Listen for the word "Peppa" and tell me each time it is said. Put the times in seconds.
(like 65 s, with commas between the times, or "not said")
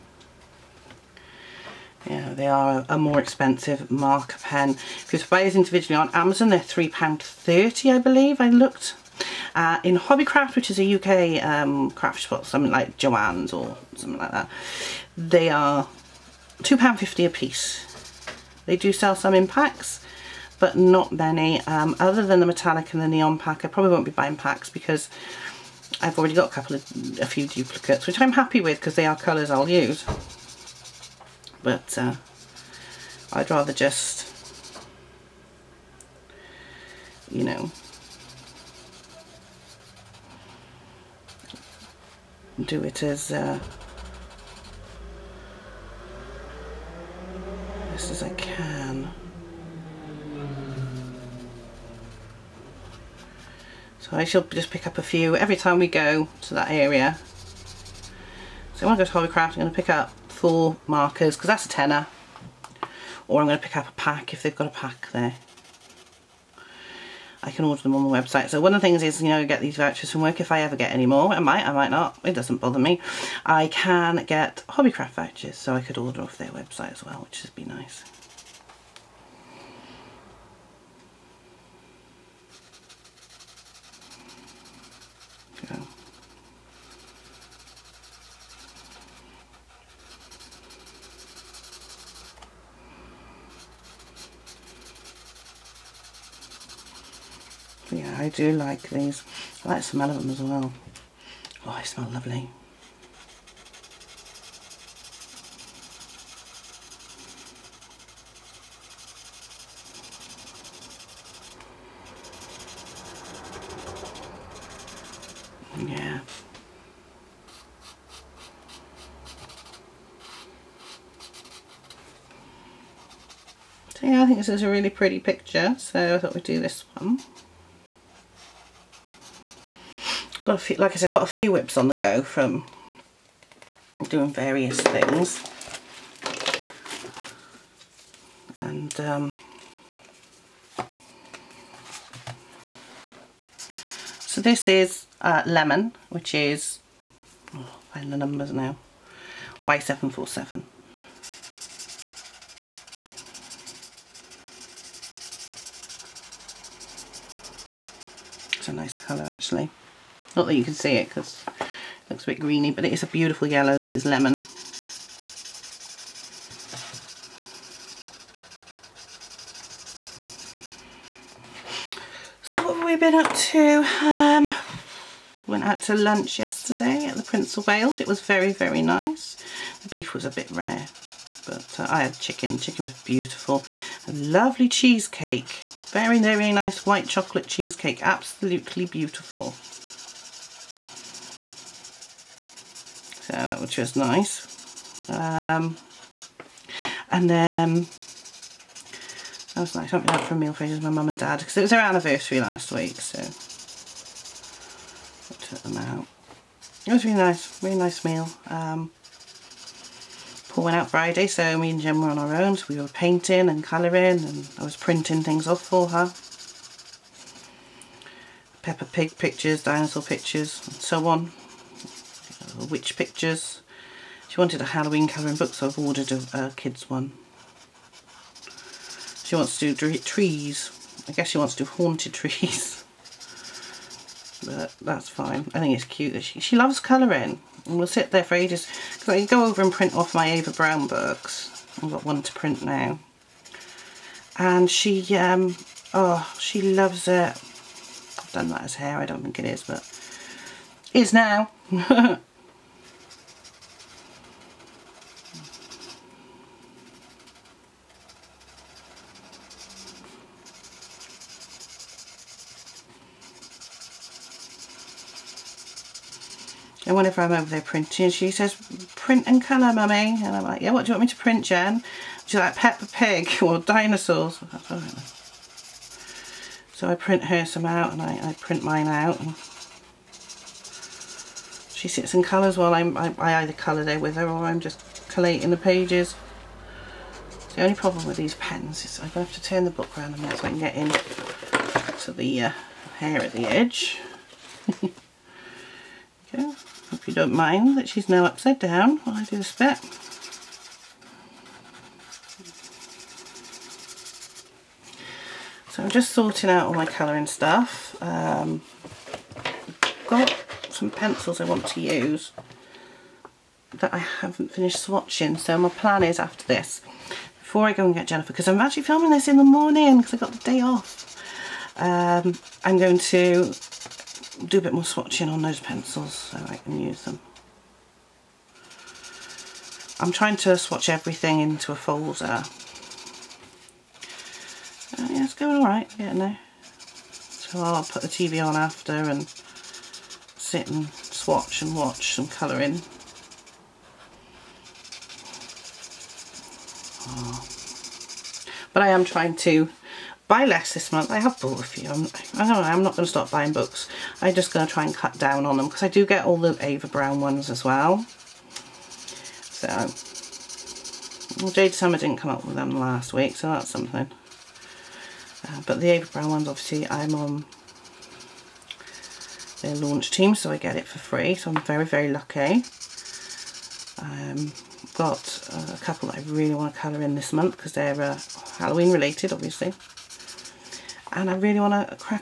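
218 s, 272 s.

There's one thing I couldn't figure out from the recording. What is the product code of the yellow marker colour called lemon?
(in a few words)
Y747.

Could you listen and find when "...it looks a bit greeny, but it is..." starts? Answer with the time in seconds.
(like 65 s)
161 s.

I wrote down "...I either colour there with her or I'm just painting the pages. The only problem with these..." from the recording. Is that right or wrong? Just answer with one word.
wrong.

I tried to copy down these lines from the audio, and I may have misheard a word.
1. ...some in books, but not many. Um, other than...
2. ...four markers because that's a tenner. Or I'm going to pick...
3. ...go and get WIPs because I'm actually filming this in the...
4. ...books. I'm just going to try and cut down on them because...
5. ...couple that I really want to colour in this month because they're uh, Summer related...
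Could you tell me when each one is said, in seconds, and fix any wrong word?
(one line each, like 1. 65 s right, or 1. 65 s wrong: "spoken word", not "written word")
1. 19 s wrong: "packs", not "books"
2. 60 s right
3. 317 s wrong: "Jennifer", not "WIPs"
4. 353 s right
5. 375 s wrong: "Halloween", not "Summer".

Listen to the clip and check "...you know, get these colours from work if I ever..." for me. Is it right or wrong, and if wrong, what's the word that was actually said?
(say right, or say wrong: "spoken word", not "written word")
wrong: "vouchers", not "colours".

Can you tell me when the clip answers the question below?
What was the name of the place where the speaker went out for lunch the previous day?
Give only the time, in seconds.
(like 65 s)
177 s.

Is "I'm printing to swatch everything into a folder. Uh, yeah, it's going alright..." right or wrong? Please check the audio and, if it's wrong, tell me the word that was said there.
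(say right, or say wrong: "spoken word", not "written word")
wrong: "trying", not "printing".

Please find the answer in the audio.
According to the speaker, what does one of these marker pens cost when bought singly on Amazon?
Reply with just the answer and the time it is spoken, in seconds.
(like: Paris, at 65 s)
£3.30, at 6 s.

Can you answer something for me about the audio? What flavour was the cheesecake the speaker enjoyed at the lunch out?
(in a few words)
White chocolate.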